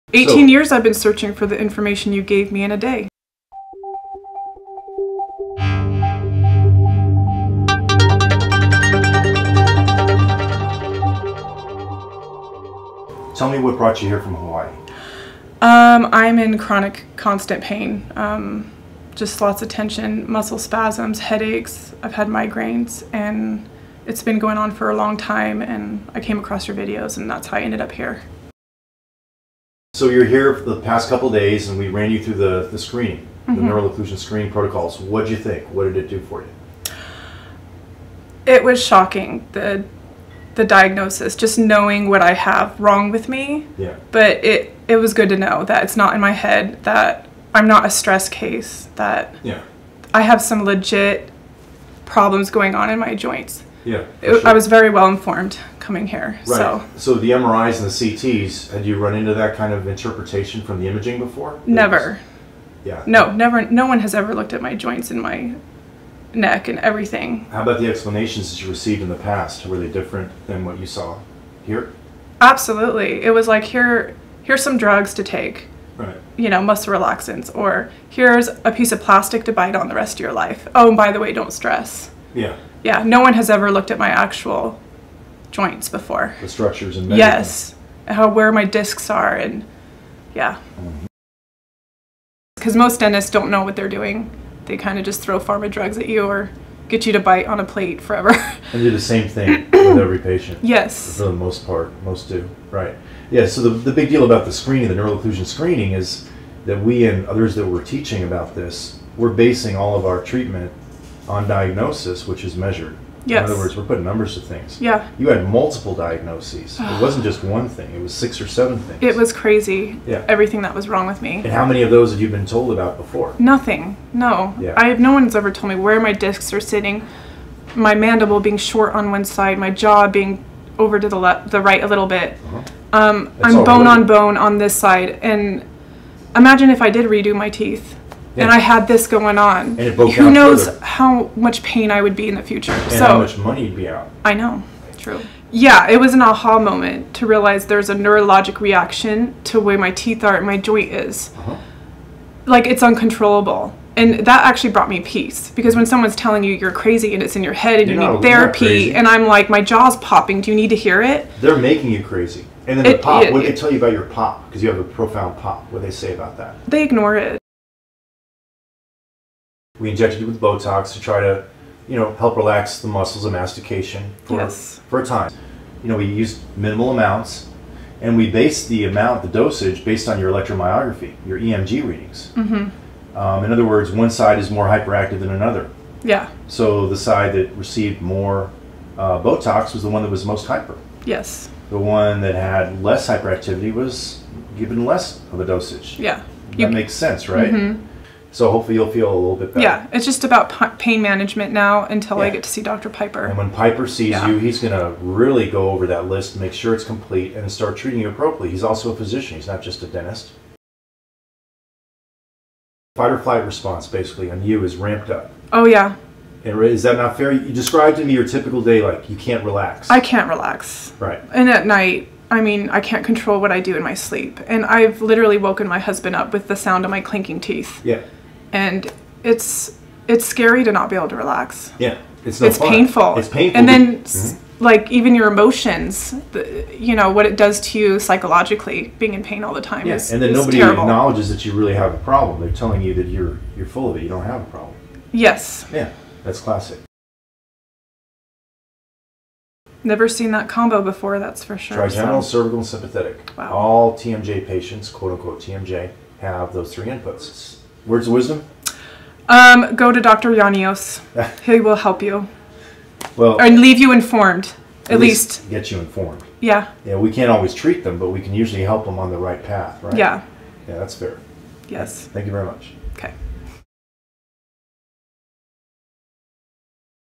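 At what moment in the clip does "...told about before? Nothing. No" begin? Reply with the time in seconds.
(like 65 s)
122 s.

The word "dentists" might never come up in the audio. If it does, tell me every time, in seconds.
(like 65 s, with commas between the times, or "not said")
92 s, 209 s.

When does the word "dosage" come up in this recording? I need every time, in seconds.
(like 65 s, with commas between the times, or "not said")
179 s, 195 s.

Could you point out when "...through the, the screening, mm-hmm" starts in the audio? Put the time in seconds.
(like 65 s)
32 s.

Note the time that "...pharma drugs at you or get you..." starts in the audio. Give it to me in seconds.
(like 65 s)
95 s.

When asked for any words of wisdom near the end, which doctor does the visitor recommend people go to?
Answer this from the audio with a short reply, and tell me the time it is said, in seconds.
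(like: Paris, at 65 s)
Dr. Yiannios, at 259 s.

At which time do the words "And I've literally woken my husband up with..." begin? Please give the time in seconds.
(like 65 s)
224 s.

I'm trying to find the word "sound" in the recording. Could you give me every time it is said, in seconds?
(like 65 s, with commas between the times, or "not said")
226 s.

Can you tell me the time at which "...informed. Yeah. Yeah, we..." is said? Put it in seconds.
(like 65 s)
265 s.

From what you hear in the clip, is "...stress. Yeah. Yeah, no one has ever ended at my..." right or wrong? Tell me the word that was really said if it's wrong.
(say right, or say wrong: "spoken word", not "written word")
wrong: "looked", not "ended".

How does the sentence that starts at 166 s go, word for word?
They ignore it we injected you with Botox to try to, you know, help relax the muscles of mastication for, yes.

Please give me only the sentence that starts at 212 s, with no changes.
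Fight or flight response basically on you is ramped up.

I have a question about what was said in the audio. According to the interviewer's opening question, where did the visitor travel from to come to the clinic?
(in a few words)
Hawaii.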